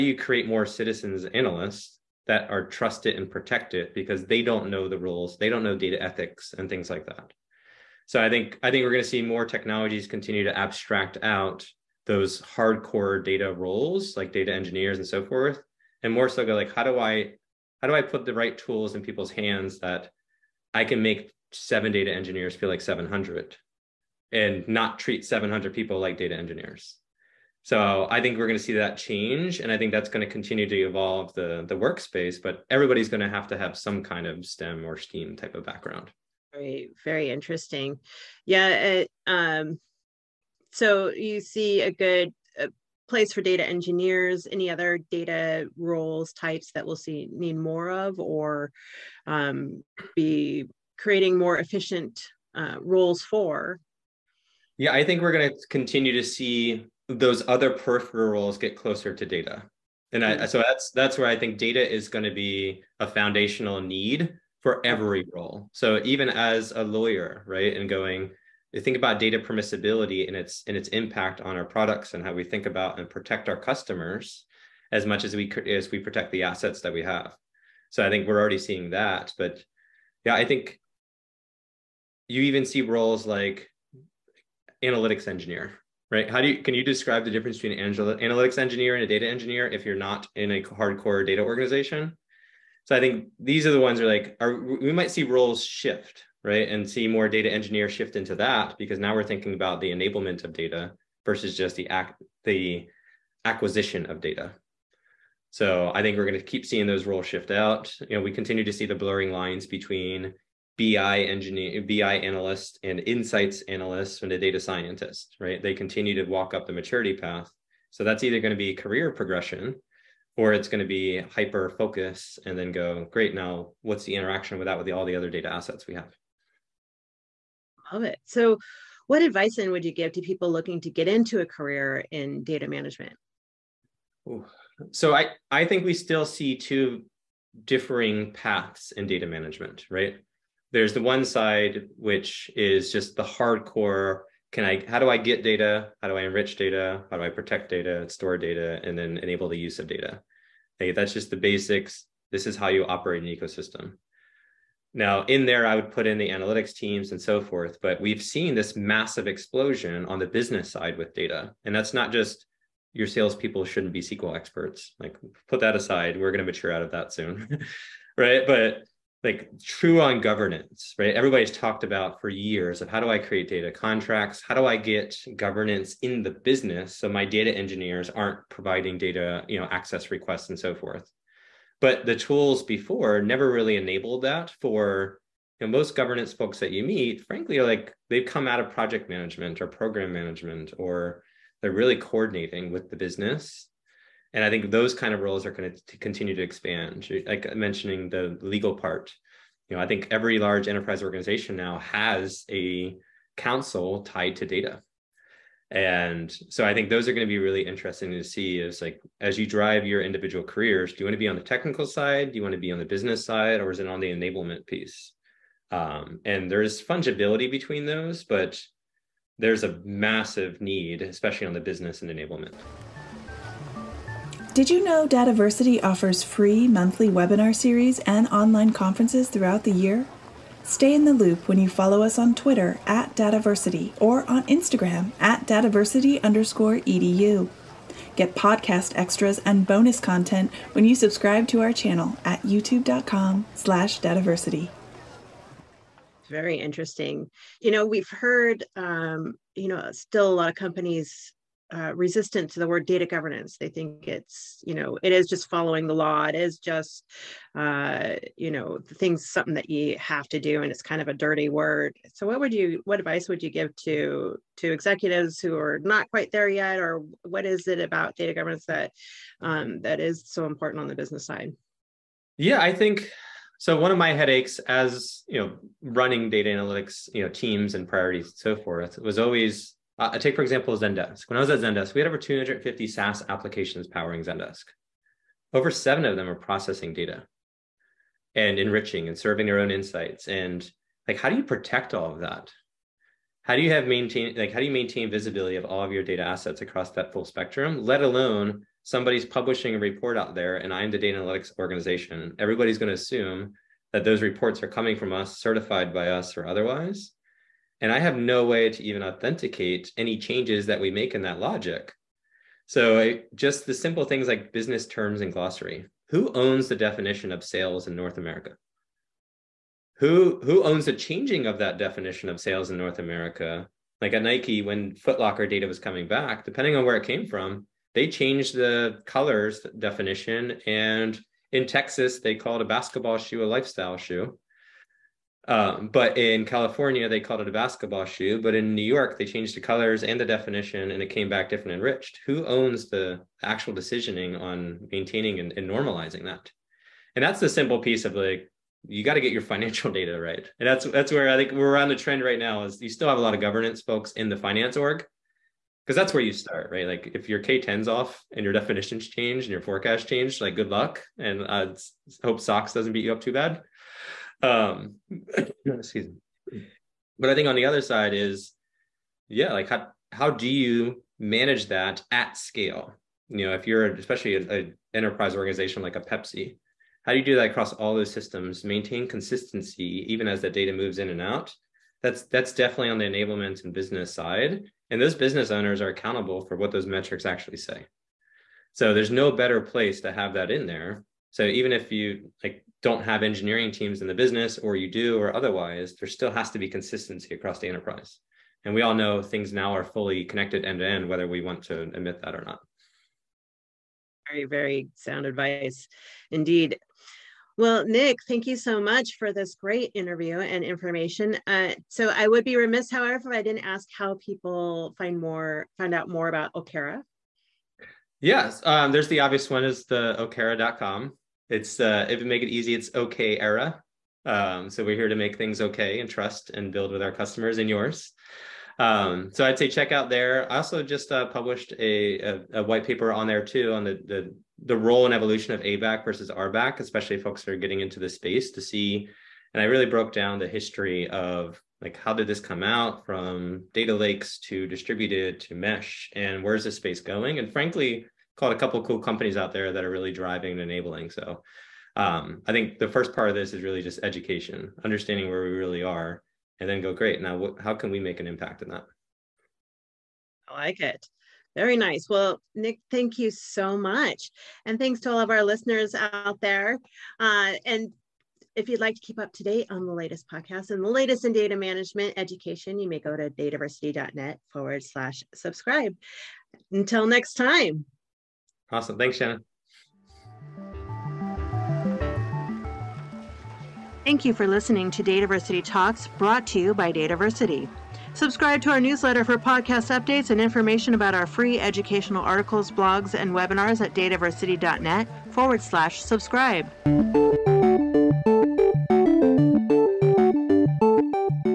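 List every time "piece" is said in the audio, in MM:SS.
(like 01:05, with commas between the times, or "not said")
03:34, 05:47.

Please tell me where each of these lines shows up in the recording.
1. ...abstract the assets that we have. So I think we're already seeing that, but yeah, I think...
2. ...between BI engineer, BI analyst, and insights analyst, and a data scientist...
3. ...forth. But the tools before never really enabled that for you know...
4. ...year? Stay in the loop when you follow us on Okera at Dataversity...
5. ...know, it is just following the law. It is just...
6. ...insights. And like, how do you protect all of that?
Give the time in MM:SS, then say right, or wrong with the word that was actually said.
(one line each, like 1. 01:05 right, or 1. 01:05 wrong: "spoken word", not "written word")
1. 01:15 wrong: "protect", not "abstract"
2. 01:49 right
3. 03:00 right
4. 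03:49 wrong: "Twitter", not "Okera"
5. 04:14 right
6. 04:49 right.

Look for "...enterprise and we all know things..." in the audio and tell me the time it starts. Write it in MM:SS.
06:37.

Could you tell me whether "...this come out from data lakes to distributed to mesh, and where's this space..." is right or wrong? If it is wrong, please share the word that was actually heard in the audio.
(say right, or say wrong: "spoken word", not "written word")
right.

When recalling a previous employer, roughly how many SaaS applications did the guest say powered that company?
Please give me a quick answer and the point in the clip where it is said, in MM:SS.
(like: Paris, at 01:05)
over 250, at 04:42.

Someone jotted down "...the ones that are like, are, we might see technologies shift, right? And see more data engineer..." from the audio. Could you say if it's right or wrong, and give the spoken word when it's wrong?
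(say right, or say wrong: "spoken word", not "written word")
wrong: "roles", not "technologies".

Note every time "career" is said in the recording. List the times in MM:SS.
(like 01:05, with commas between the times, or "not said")
01:58, 02:11, 03:30.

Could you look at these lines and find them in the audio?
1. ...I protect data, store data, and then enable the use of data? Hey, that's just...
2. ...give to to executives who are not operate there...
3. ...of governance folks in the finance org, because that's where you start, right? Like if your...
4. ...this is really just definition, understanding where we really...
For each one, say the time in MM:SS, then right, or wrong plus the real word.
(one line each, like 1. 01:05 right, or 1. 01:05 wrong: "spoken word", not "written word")
1. 02:27 right
2. 04:23 wrong: "quite", not "operate"
3. 05:53 right
4. 07:33 wrong: "education", not "definition".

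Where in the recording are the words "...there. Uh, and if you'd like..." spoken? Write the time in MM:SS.
07:46.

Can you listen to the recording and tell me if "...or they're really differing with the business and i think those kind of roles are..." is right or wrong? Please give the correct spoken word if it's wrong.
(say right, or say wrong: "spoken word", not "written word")
wrong: "coordinating", not "differing".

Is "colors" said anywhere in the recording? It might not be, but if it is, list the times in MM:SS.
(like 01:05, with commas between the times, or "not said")
05:29, 05:39.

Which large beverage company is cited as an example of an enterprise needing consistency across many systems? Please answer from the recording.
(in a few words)
Pepsi.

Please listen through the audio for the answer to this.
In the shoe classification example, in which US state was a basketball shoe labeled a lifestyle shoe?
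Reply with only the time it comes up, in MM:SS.
05:31.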